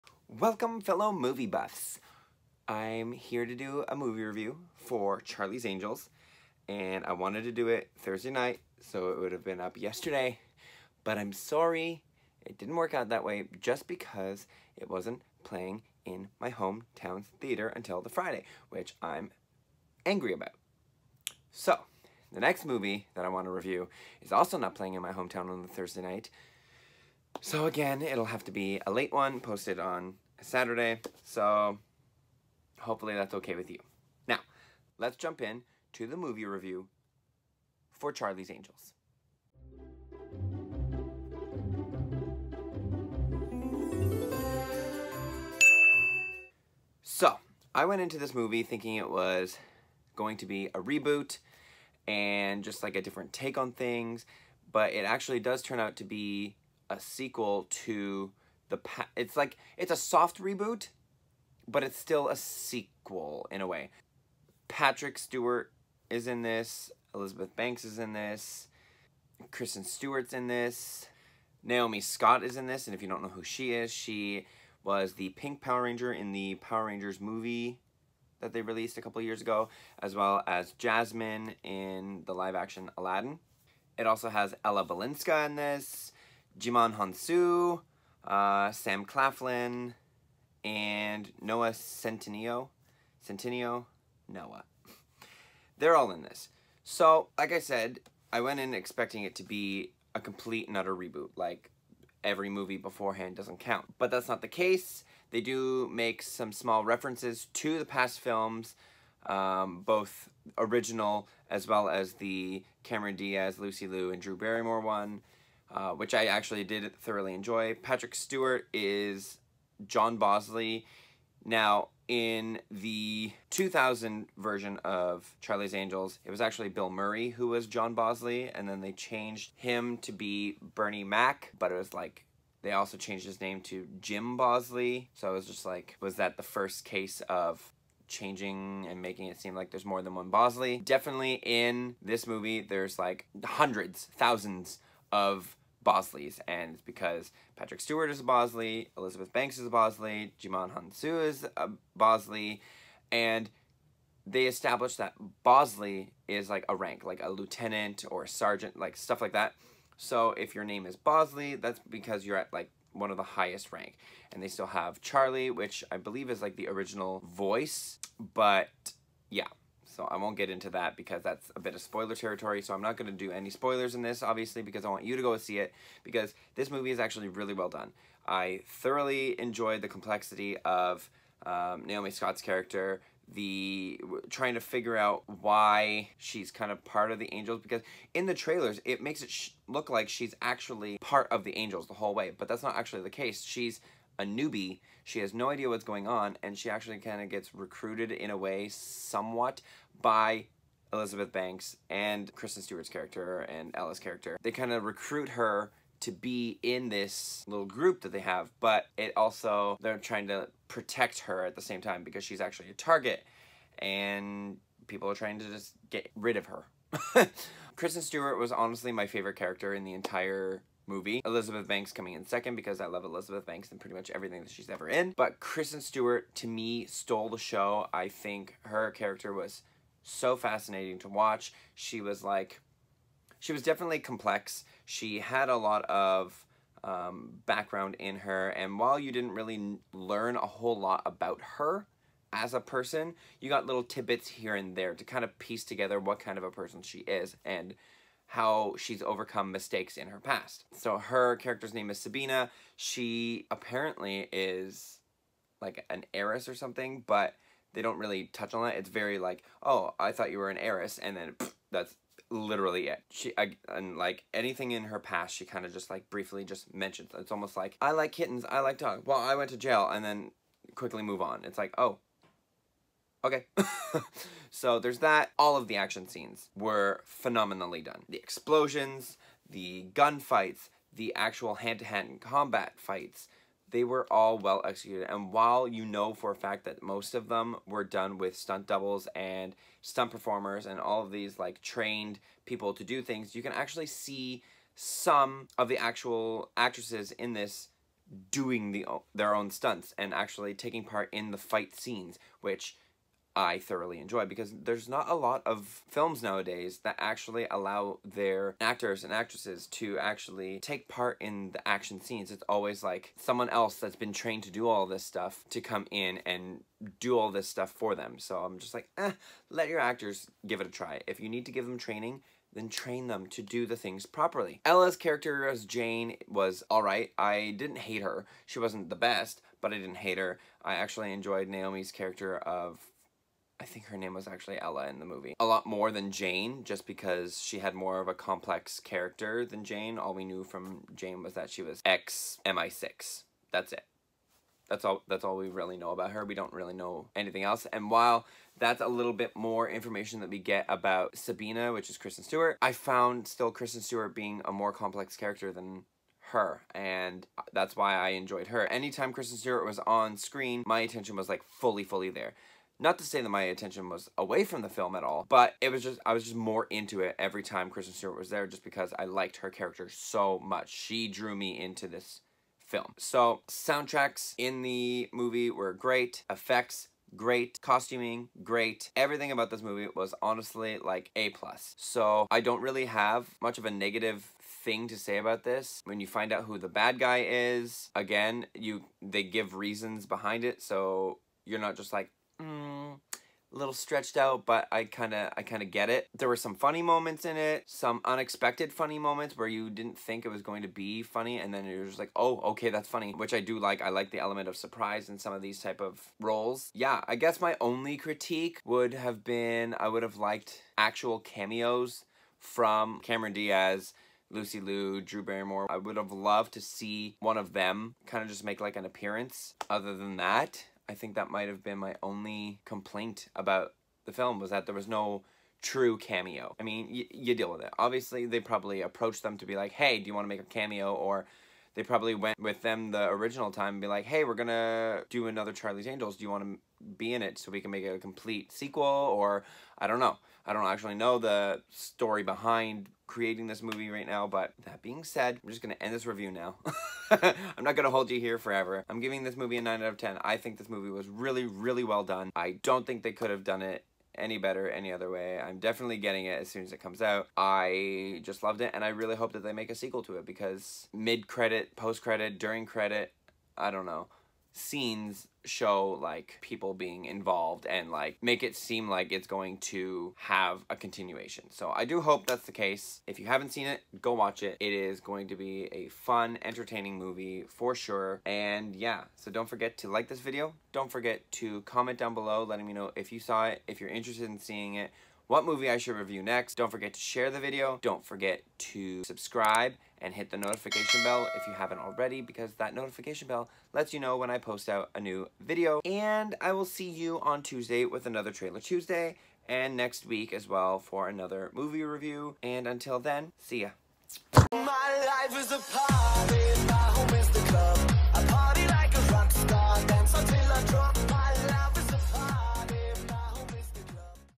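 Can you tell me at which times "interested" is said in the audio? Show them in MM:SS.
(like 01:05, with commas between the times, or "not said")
08:03.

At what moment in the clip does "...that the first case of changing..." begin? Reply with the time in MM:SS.
02:16.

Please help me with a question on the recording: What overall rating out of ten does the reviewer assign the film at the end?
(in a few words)
9.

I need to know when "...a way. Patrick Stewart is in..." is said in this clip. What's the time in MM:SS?
01:03.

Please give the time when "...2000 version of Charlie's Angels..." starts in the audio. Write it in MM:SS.
02:03.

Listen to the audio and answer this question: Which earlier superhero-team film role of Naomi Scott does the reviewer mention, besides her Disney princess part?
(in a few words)
Pink Power Ranger.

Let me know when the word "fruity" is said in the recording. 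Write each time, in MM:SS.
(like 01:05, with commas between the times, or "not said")
not said.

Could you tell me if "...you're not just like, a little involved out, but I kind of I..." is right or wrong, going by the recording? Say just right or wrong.
wrong.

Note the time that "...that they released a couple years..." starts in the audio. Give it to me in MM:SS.
01:18.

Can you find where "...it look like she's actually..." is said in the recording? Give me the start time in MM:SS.
03:09.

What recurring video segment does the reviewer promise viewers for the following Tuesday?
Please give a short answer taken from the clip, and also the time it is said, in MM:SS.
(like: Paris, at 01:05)
Trailer Tuesday, at 08:18.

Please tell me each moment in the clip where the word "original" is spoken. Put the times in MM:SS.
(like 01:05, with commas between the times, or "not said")
01:50, 02:46, 07:13.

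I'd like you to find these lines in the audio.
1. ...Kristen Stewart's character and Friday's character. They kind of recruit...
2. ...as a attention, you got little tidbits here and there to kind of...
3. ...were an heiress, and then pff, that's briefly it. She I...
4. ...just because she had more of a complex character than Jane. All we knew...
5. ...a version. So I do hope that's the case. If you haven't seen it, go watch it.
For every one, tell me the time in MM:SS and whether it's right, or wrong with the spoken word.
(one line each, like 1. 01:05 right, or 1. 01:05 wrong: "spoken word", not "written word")
1. 03:22 wrong: "Ella", not "Friday"
2. 04:02 wrong: "person", not "attention"
3. 04:20 wrong: "literally", not "briefly"
4. 05:36 right
5. 07:50 wrong: "continuation", not "version".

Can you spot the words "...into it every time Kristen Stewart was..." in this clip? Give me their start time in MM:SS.
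06:06.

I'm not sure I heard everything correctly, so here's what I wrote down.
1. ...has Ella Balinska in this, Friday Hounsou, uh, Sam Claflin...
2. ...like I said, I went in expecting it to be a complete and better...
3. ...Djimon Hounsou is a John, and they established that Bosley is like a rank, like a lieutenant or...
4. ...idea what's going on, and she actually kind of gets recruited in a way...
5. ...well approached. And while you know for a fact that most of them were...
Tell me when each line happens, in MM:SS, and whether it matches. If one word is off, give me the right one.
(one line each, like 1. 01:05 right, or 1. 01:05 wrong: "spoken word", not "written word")
1. 01:24 wrong: "Djimon", not "Friday"
2. 01:37 wrong: "utter", not "better"
3. 02:30 wrong: "Bosley", not "John"
4. 03:15 right
5. 04:44 wrong: "executed", not "approached".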